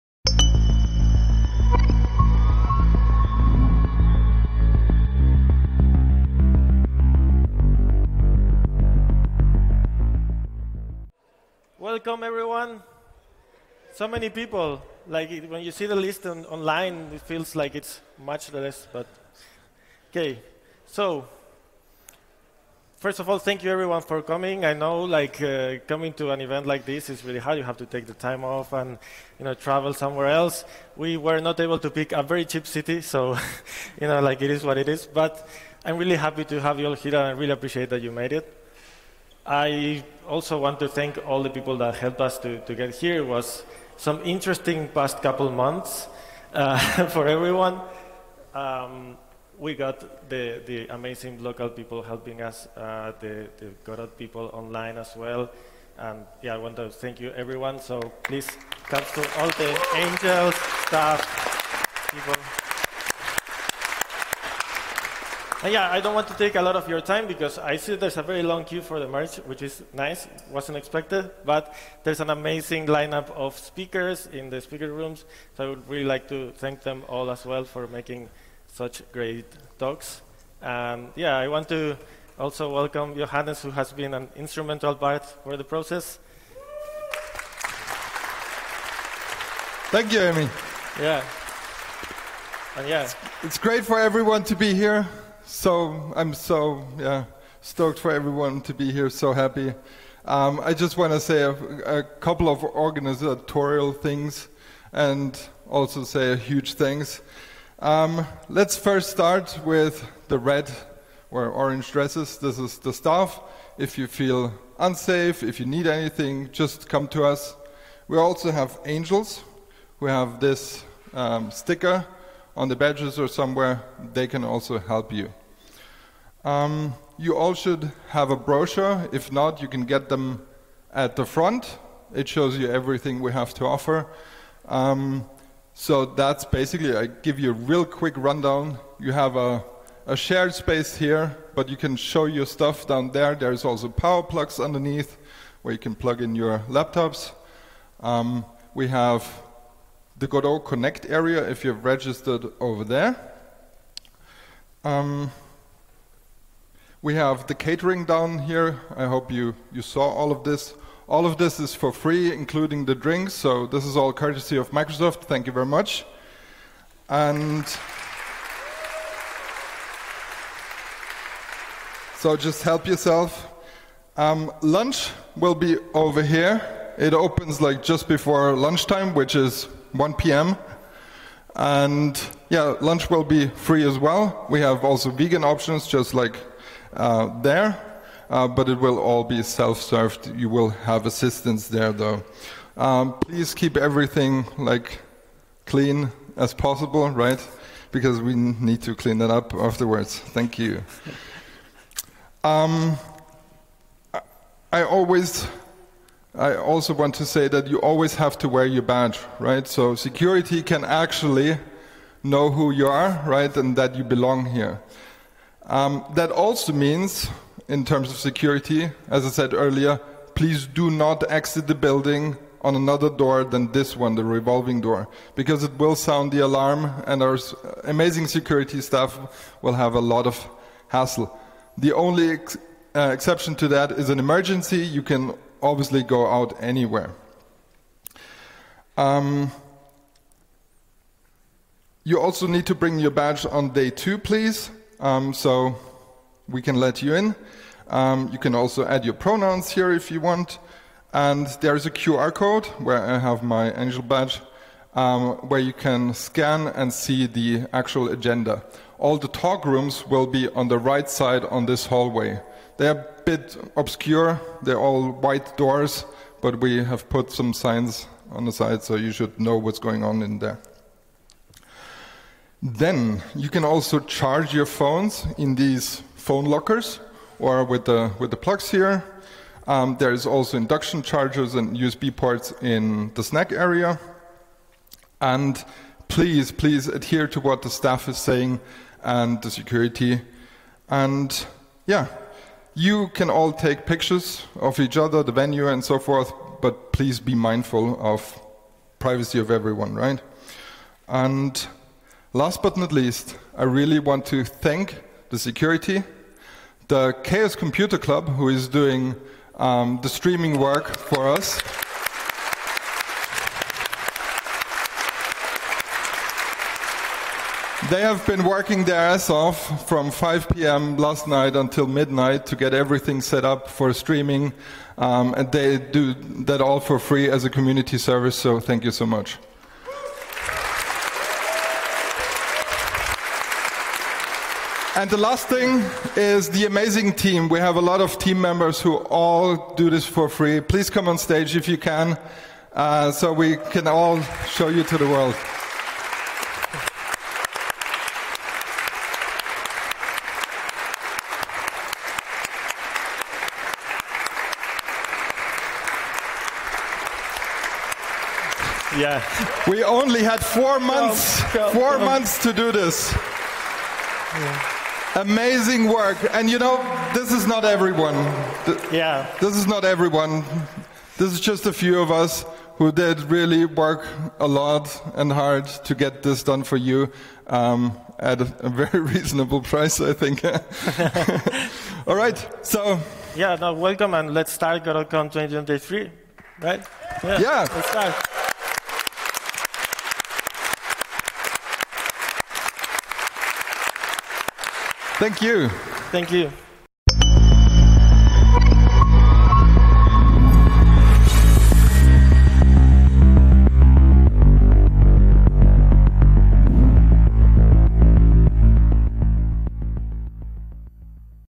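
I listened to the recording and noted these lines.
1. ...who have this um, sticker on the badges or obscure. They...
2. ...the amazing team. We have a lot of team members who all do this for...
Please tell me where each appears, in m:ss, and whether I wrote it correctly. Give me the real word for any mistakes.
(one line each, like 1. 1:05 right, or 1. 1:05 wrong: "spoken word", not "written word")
1. 1:59 wrong: "somewhere", not "obscure"
2. 5:36 right.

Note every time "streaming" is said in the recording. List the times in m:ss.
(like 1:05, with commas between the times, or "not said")
5:10, 5:23.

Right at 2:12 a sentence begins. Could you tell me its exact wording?
It shows you everything we have to offer.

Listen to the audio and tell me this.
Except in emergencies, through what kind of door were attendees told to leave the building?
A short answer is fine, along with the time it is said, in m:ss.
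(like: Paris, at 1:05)
revolving door, at 3:44.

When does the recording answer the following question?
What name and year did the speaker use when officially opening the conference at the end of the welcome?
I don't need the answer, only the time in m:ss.
6:24.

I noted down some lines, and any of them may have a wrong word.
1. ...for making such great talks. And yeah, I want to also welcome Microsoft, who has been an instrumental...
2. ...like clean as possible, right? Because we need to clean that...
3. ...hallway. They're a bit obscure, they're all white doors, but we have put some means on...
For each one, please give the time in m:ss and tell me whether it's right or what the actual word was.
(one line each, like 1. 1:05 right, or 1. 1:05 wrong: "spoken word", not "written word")
1. 1:17 wrong: "Johannes", not "Microsoft"
2. 3:14 right
3. 4:21 wrong: "signs", not "means".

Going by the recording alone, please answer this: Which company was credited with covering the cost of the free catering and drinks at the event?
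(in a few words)
Microsoft.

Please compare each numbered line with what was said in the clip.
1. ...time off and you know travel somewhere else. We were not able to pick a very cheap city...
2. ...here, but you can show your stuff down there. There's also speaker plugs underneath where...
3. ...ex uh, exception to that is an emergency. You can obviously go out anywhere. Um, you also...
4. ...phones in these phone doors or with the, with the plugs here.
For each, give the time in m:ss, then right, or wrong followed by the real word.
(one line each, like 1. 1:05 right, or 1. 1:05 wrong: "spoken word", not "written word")
1. 0:28 right
2. 2:20 wrong: "power", not "speaker"
3. 3:52 right
4. 4:34 wrong: "lockers", not "doors".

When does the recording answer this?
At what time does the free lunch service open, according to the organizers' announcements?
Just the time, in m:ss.
2:59.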